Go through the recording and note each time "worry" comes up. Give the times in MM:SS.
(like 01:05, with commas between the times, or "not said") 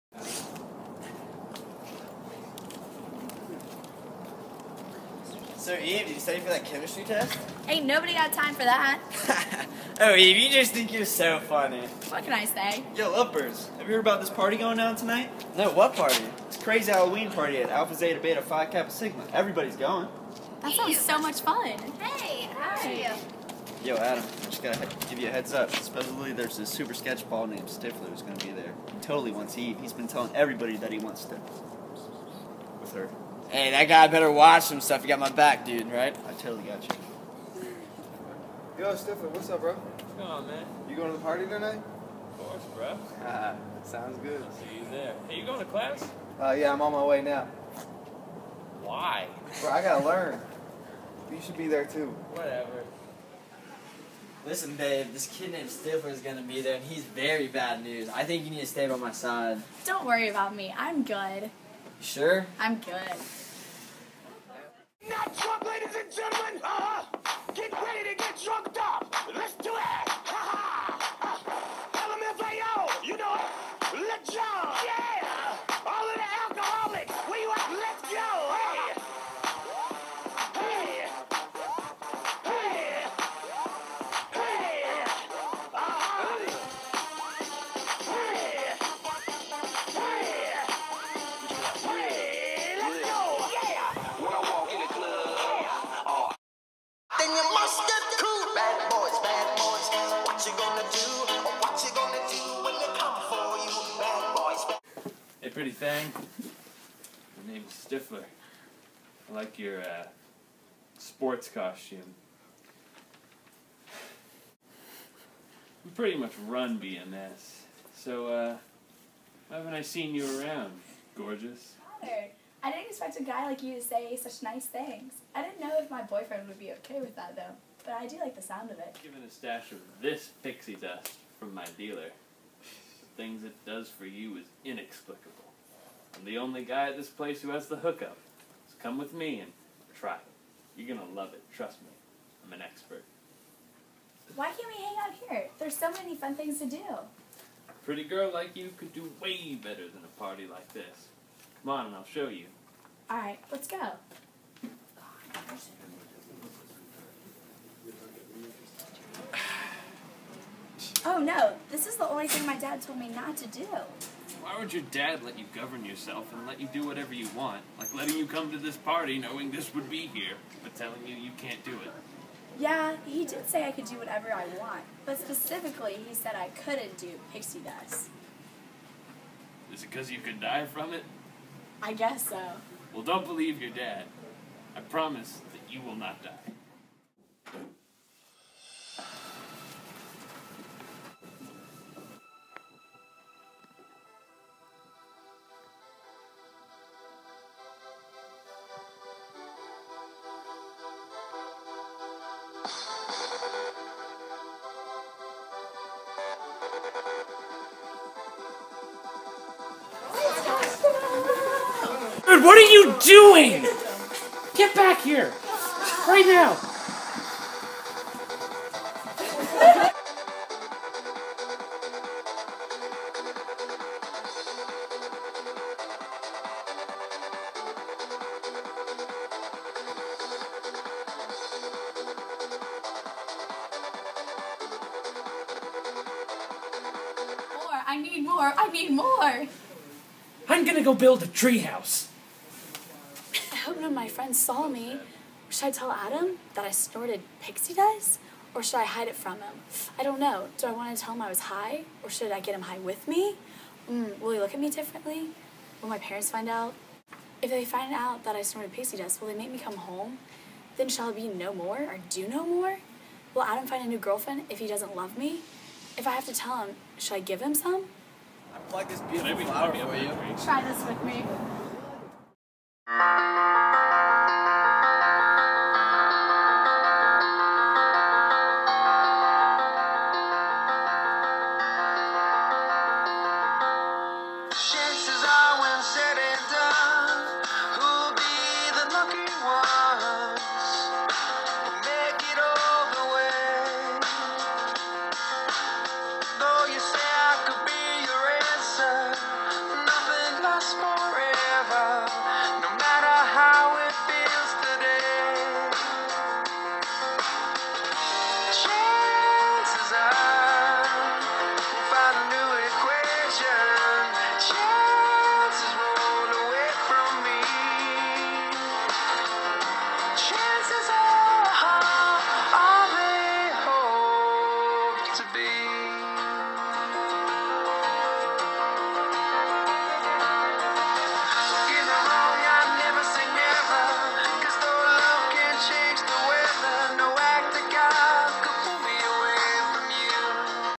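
01:00.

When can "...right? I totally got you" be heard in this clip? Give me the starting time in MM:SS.
00:35.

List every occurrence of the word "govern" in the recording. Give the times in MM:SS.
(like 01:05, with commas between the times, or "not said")
02:45.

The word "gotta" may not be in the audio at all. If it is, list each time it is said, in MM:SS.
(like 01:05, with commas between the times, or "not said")
00:24, 00:49.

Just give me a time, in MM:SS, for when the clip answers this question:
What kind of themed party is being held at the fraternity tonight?
00:16.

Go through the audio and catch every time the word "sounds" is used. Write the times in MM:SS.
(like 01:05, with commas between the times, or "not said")
00:20, 00:43, 02:08.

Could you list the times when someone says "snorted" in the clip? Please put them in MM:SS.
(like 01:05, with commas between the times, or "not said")
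04:06, 04:18.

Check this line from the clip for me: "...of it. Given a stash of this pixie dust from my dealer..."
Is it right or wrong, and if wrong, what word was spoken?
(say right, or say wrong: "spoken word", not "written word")
right.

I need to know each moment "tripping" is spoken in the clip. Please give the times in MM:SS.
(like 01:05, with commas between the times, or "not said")
not said.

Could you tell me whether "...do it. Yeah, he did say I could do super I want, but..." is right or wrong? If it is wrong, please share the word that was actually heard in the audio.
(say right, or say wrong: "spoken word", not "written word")
wrong: "whatever", not "super".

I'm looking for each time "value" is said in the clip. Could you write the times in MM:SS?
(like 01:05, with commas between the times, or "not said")
not said.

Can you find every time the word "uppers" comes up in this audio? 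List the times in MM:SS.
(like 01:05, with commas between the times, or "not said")
00:13.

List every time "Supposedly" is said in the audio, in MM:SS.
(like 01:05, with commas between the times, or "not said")
00:25.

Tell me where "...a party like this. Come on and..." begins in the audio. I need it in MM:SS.
02:30.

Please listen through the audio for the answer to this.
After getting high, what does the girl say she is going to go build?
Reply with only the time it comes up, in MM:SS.
04:01.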